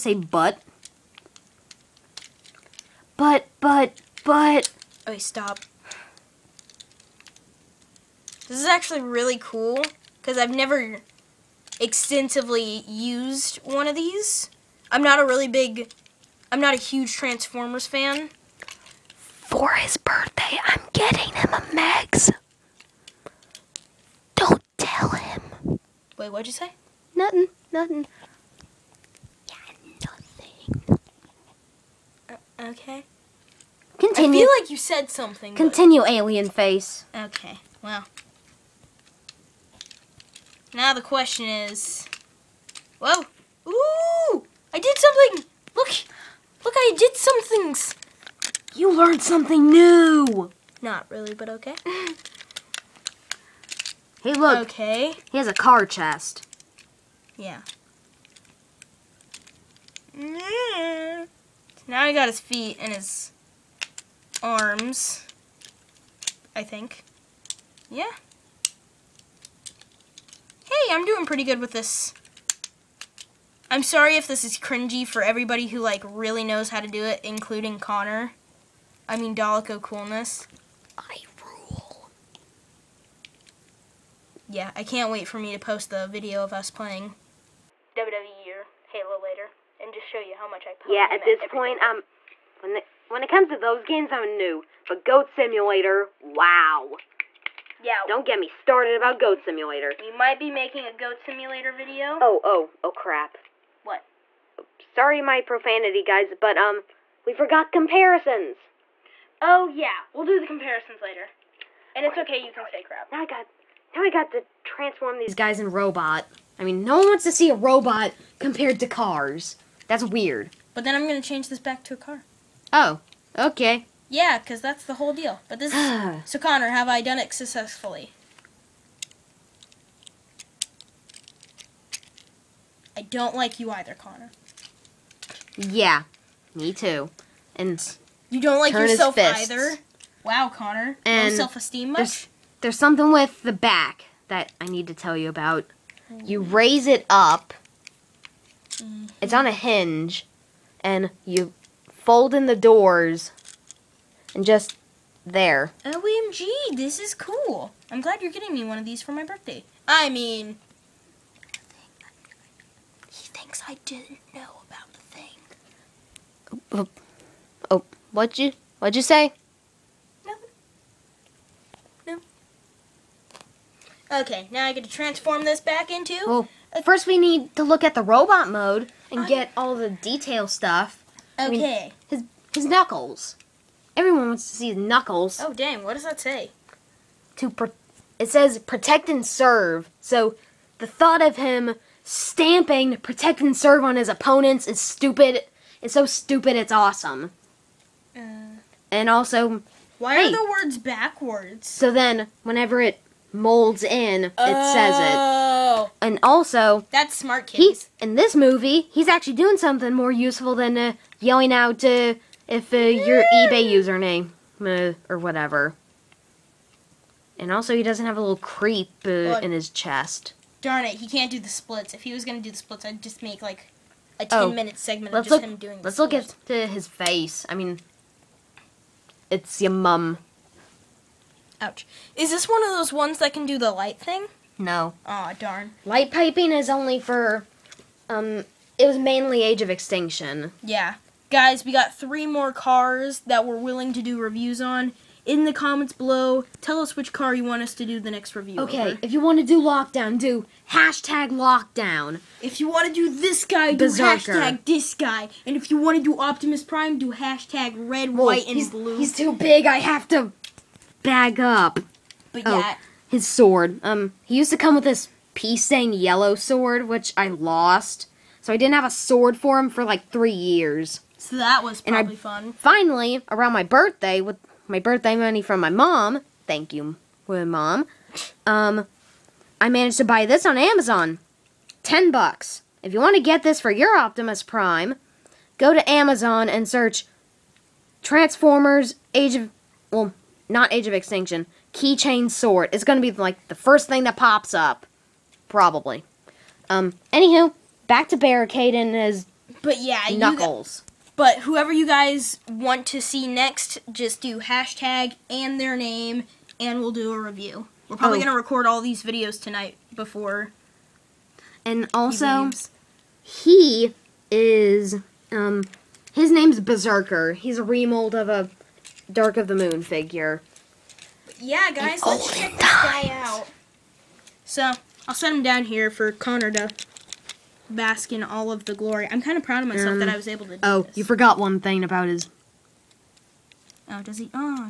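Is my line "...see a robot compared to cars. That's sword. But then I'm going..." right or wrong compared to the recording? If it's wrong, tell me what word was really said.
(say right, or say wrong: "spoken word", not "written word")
wrong: "weird", not "sword".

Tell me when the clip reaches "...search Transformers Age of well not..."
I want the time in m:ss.
4:46.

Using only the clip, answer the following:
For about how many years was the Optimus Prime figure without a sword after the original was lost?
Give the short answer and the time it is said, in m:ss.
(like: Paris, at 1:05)
3 years, at 4:30.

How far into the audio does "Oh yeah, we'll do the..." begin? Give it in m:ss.
1:49.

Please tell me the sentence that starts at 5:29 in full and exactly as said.
I'm kind of proud of myself um, that I was able to do Oh, this.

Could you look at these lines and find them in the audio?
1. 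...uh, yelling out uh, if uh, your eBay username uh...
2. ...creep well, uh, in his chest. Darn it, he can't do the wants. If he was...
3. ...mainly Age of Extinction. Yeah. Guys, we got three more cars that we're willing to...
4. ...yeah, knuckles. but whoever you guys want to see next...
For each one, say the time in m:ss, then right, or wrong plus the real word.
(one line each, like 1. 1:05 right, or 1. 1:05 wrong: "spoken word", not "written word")
1. 3:30 right
2. 3:38 wrong: "splits", not "wants"
3. 3:58 right
4. 4:59 right.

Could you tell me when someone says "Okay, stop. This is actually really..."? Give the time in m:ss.
0:05.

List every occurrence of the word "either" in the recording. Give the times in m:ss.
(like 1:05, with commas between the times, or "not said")
2:13, 2:19.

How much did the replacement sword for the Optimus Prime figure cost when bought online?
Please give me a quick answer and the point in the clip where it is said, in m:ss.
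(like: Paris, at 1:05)
10 dollars, at 4:41.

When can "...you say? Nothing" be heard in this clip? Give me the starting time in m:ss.
0:26.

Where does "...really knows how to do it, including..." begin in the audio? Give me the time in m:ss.
1:16.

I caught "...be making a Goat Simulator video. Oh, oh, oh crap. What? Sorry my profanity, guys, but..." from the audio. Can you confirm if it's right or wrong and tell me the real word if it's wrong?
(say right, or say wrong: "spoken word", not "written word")
right.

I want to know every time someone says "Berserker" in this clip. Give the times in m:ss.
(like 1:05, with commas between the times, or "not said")
4:13, 5:16.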